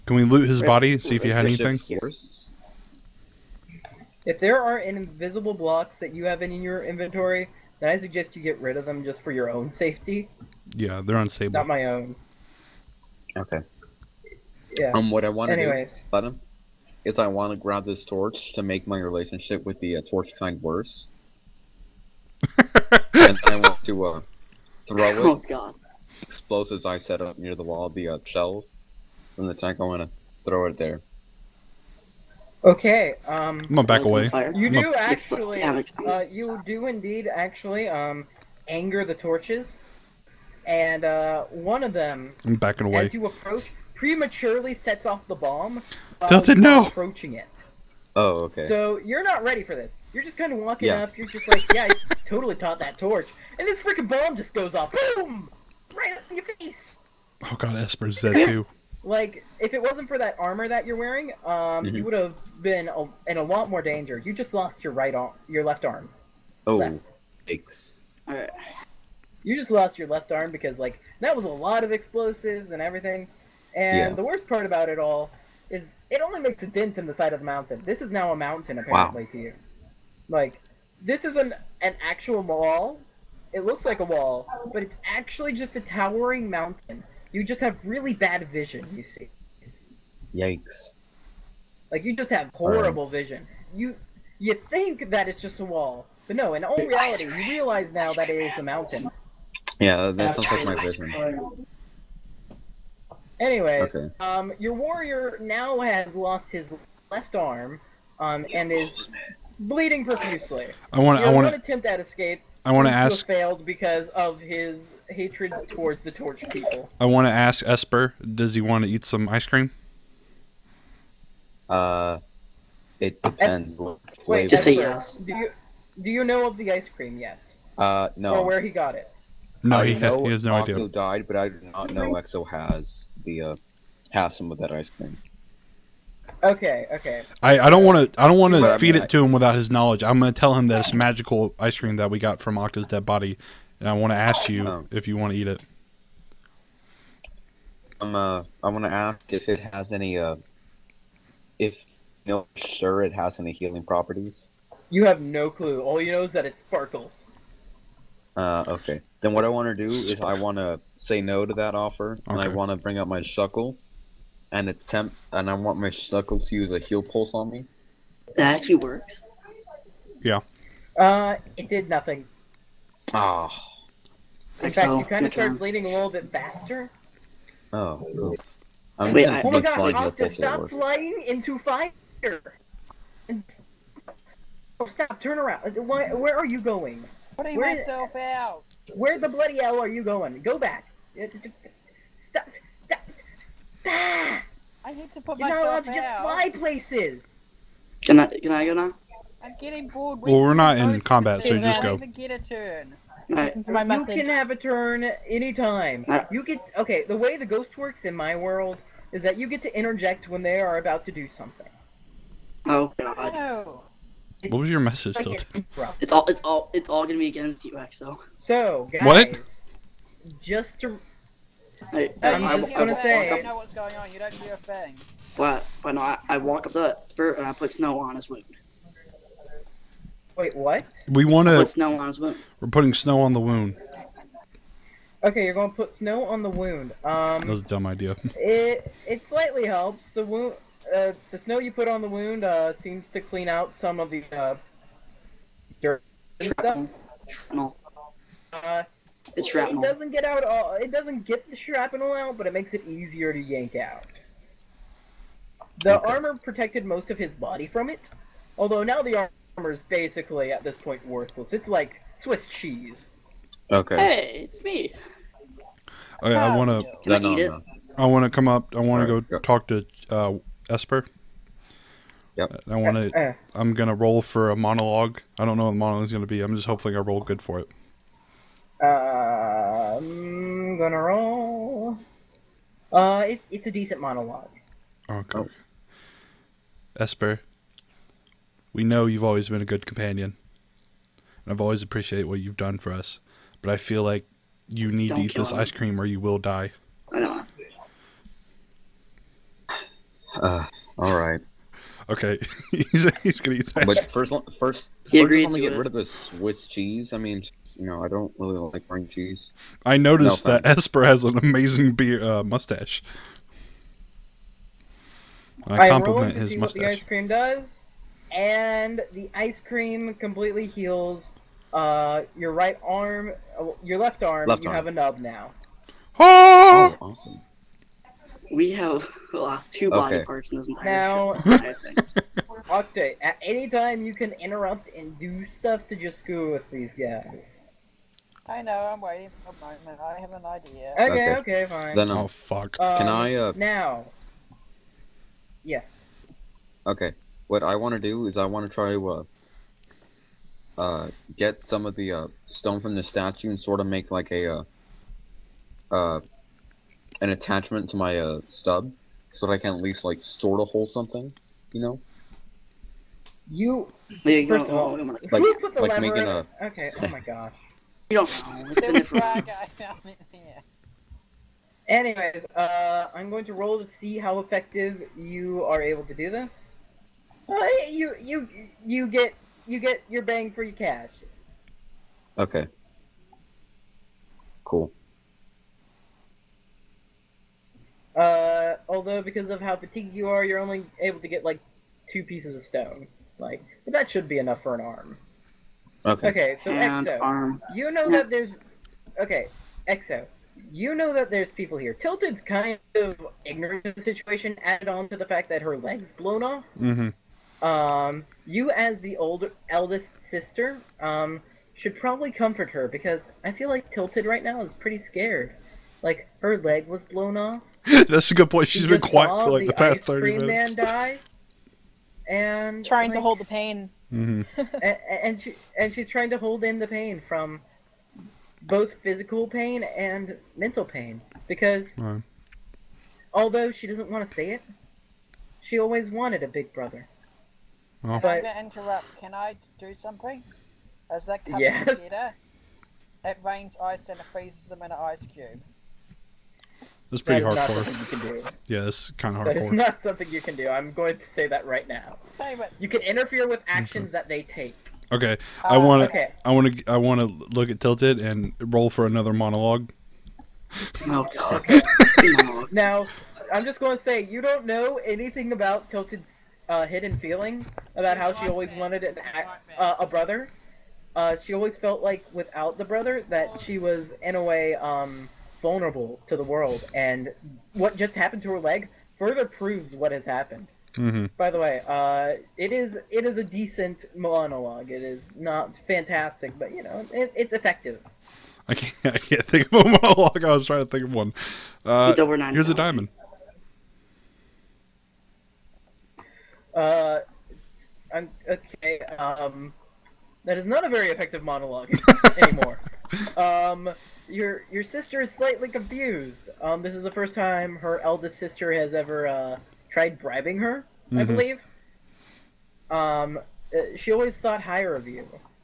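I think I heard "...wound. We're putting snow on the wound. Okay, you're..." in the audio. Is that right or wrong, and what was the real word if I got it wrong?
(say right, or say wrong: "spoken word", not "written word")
right.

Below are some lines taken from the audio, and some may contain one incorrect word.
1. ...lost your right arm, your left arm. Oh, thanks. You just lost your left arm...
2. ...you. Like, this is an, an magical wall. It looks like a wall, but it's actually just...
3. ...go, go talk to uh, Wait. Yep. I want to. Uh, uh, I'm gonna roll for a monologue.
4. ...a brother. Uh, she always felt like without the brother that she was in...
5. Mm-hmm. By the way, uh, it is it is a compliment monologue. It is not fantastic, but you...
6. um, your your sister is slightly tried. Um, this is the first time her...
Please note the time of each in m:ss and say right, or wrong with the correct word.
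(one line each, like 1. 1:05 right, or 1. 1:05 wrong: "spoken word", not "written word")
1. 1:04 right
2. 1:19 wrong: "actual", not "magical"
3. 4:29 wrong: "Esper", not "Wait"
4. 7:49 right
5. 8:00 wrong: "decent", not "compliment"
6. 8:23 wrong: "confused", not "tried".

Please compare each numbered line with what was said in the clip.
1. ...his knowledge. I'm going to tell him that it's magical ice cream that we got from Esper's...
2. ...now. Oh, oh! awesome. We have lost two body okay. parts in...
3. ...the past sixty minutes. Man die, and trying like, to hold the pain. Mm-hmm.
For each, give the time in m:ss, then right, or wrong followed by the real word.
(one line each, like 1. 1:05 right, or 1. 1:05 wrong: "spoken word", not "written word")
1. 2:19 wrong: "Octo", not "Esper"
2. 5:25 right
3. 6:59 wrong: "thirty", not "sixty".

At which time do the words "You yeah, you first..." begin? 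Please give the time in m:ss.
6:03.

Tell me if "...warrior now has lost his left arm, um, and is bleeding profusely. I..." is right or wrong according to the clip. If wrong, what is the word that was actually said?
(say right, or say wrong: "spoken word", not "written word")
right.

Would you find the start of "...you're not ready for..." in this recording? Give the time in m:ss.
0:49.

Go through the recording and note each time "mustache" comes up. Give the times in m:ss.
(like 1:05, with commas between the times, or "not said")
5:12, 5:16.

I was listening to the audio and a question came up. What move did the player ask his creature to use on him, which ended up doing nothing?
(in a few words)
Heal Pulse.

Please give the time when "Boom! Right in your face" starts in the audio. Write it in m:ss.
0:55.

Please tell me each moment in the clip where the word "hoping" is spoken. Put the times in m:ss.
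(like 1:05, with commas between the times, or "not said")
4:36.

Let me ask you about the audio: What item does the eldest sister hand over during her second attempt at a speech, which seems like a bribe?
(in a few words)
a diamond.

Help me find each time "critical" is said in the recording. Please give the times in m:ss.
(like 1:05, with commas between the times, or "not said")
not said.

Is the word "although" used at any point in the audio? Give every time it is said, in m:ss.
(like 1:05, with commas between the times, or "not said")
4:18, 6:28, 7:13.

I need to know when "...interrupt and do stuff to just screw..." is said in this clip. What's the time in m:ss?
5:34.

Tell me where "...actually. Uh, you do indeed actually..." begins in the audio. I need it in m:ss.
0:34.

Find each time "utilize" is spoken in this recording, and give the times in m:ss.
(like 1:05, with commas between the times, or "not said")
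not said.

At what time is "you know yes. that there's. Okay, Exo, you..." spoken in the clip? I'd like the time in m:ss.
6:37.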